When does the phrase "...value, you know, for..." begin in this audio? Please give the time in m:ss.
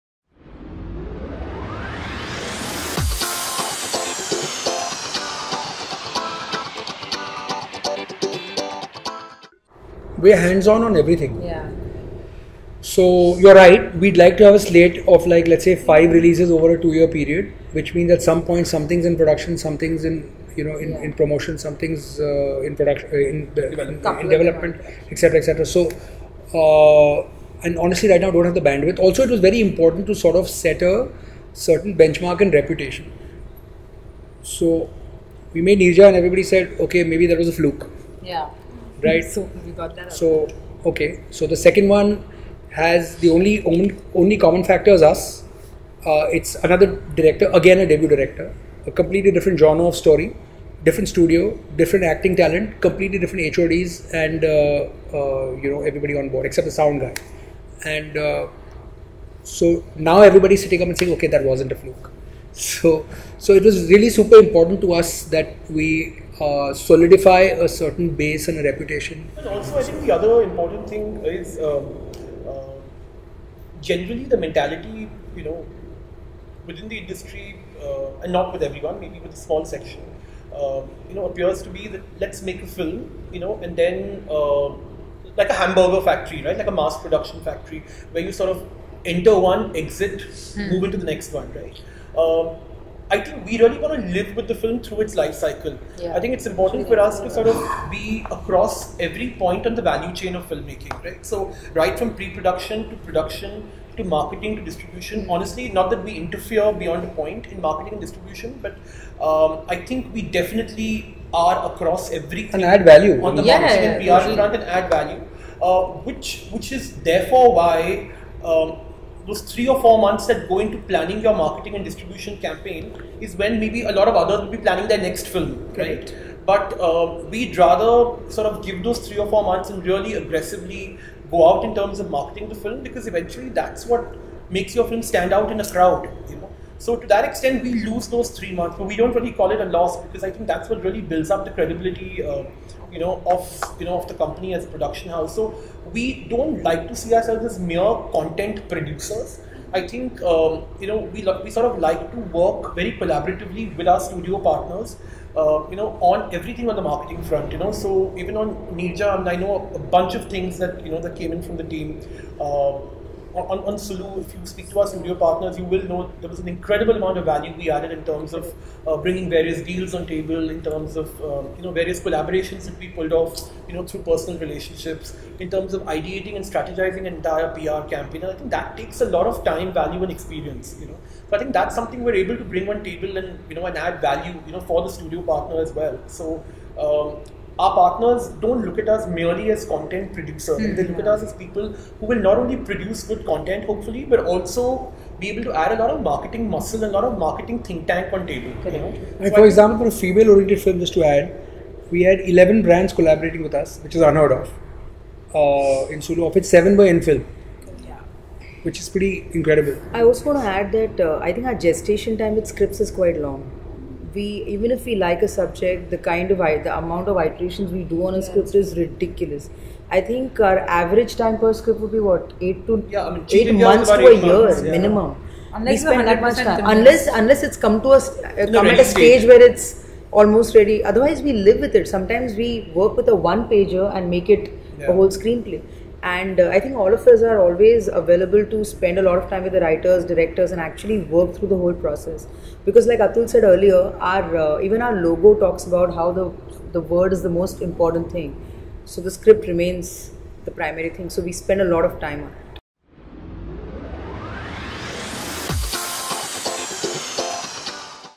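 3:04.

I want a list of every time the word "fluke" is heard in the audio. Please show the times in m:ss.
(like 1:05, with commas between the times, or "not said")
0:37, 1:01.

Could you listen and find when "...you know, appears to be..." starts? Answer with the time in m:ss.
1:21.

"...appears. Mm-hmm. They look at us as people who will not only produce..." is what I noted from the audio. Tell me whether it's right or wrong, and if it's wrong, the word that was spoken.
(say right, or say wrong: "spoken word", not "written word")
wrong: "producers", not "appears".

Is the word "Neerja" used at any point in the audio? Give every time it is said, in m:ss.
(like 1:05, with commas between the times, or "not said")
0:35, 2:38.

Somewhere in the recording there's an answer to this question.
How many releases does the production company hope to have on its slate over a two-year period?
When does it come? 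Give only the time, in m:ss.
0:15.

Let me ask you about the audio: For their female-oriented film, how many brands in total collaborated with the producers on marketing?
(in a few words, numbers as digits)
11.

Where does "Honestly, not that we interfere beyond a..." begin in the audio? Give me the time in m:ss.
1:45.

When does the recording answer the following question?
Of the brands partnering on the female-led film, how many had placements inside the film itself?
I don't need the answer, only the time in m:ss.
3:26.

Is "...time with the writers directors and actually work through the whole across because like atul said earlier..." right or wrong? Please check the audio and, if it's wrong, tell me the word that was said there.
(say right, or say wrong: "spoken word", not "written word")
wrong: "process", not "across".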